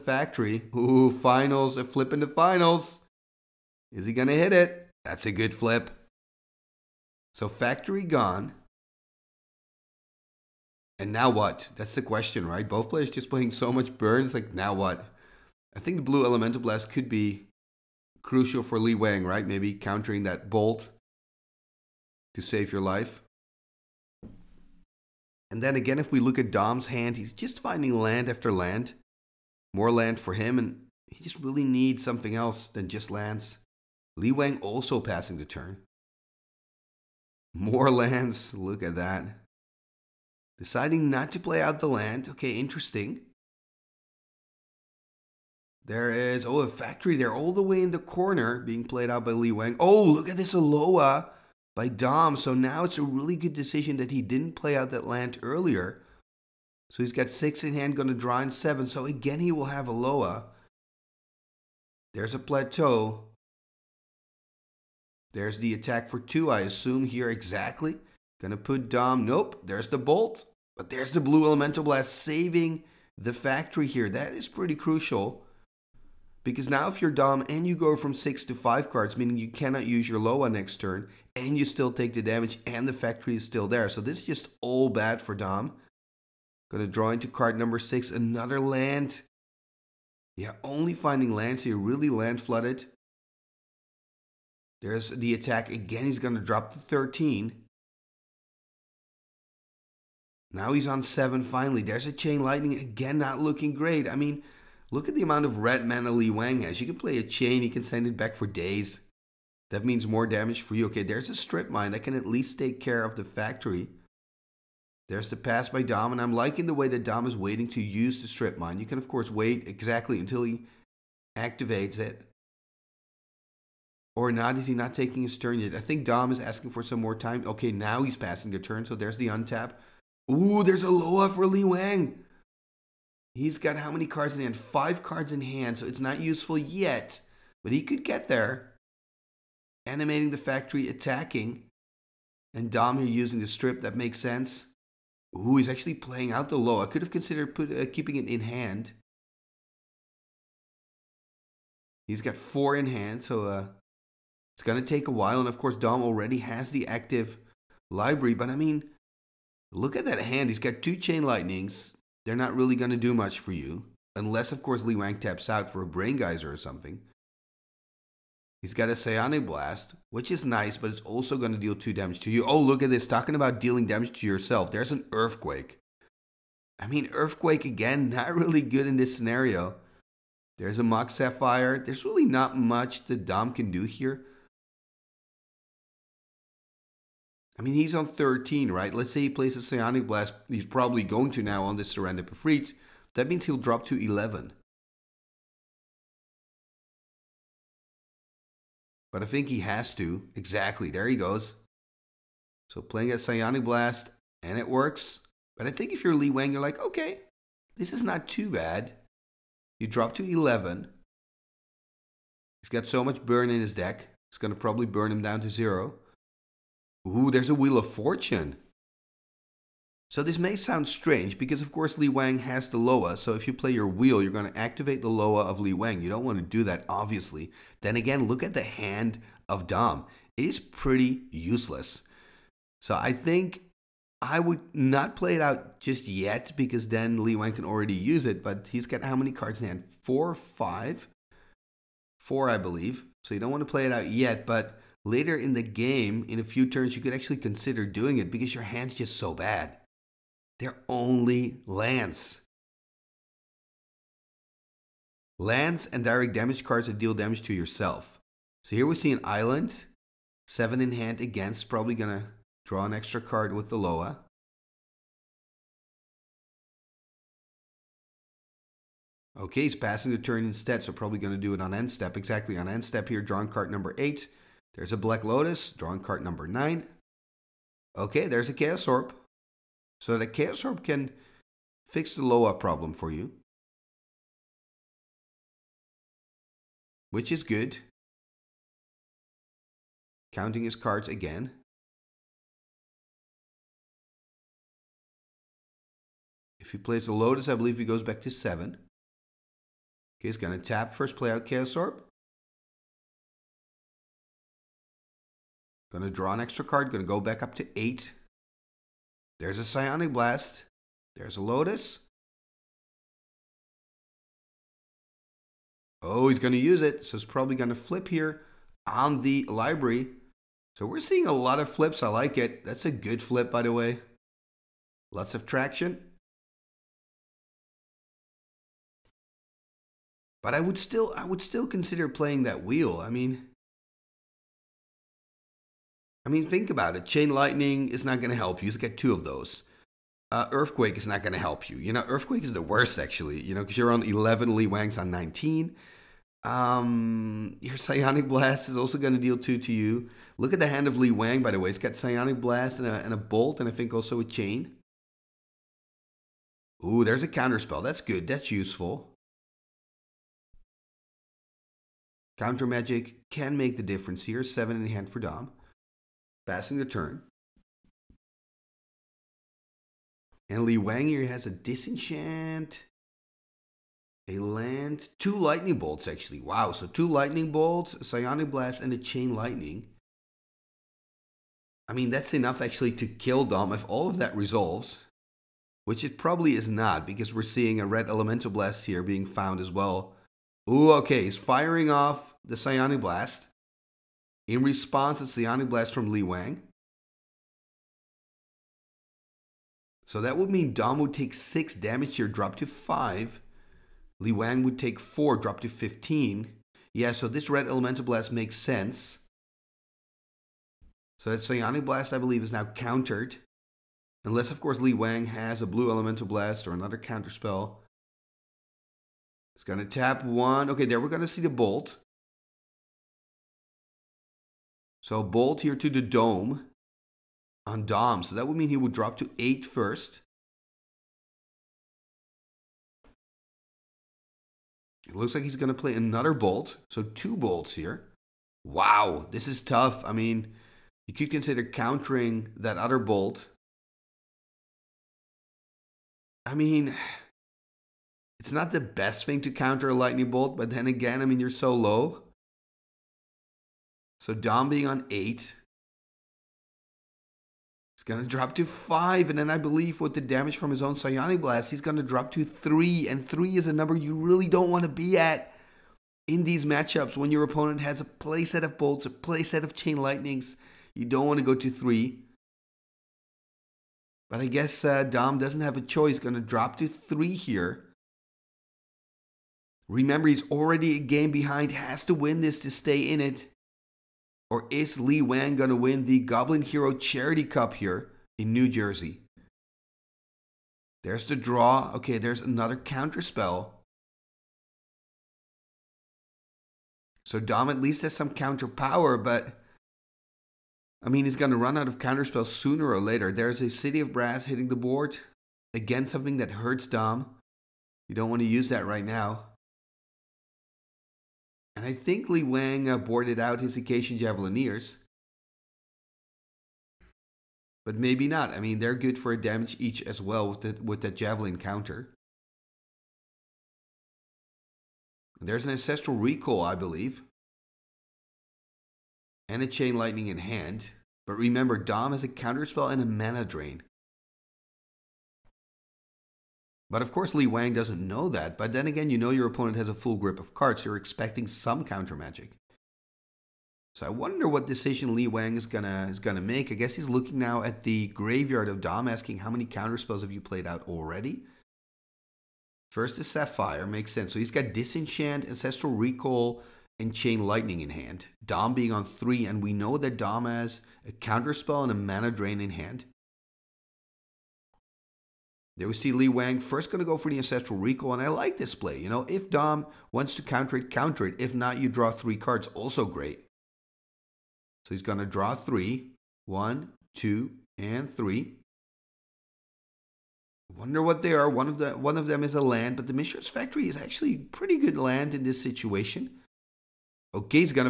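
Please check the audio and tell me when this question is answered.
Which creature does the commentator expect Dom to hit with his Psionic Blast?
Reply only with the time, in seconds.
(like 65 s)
191 s.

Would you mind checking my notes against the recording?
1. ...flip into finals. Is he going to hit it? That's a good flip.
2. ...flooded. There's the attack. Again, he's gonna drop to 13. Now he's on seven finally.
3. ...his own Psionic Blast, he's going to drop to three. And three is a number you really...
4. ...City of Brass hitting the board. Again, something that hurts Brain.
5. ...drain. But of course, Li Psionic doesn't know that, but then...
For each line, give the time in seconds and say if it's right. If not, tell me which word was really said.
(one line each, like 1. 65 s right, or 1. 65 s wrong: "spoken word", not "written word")
1. 1 s right
2. 92 s right
3. 460 s right
4. 503 s wrong: "Dom", not "Brain"
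5. 533 s wrong: "Wang", not "Psionic".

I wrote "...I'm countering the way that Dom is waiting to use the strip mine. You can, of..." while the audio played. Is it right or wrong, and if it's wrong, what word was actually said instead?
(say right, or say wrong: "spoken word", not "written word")
wrong: "liking", not "countering".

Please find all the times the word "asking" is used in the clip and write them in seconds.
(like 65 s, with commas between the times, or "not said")
126 s, 549 s.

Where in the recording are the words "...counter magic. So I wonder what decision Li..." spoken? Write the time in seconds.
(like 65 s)
541 s.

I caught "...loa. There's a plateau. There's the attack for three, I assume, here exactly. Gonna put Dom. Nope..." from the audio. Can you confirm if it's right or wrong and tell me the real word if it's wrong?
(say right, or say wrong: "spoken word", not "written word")
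wrong: "two", not "three".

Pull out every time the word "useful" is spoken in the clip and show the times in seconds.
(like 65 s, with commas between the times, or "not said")
136 s, 358 s.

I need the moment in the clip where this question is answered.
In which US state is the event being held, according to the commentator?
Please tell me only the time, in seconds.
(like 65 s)
488 s.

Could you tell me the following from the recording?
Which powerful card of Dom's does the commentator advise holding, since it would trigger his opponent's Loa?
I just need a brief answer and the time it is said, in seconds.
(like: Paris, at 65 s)
Wheel of Fortune, at 217 s.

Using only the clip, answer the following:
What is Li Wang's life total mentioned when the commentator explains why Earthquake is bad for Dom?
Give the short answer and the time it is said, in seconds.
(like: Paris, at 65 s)
19, at 345 s.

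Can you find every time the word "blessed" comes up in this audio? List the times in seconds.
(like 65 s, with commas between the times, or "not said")
not said.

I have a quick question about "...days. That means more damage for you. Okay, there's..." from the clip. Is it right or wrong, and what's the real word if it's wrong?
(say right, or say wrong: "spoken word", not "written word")
right.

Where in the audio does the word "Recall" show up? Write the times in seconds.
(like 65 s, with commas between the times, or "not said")
526 s, 555 s, 567 s.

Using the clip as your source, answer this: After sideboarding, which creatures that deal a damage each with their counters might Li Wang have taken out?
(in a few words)
Icatian Javelineers.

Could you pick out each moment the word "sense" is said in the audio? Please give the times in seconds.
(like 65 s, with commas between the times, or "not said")
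144 s, 408 s, 554 s.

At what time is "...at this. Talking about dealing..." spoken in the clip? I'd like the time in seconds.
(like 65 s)
172 s.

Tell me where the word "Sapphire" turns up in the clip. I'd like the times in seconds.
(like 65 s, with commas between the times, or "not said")
181 s, 553 s.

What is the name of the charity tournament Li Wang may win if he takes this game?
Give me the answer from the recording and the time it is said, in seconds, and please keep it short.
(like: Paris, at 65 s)
Goblin Hero Charity Cup, at 486 s.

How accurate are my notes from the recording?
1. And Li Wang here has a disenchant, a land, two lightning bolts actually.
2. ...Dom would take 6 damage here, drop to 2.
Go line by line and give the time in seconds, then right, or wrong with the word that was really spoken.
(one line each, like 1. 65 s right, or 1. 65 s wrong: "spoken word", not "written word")
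1. 370 s right
2. 400 s wrong: "5", not "2".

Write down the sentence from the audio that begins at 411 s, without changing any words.
So that Psionic Blast, I believe, is now countered.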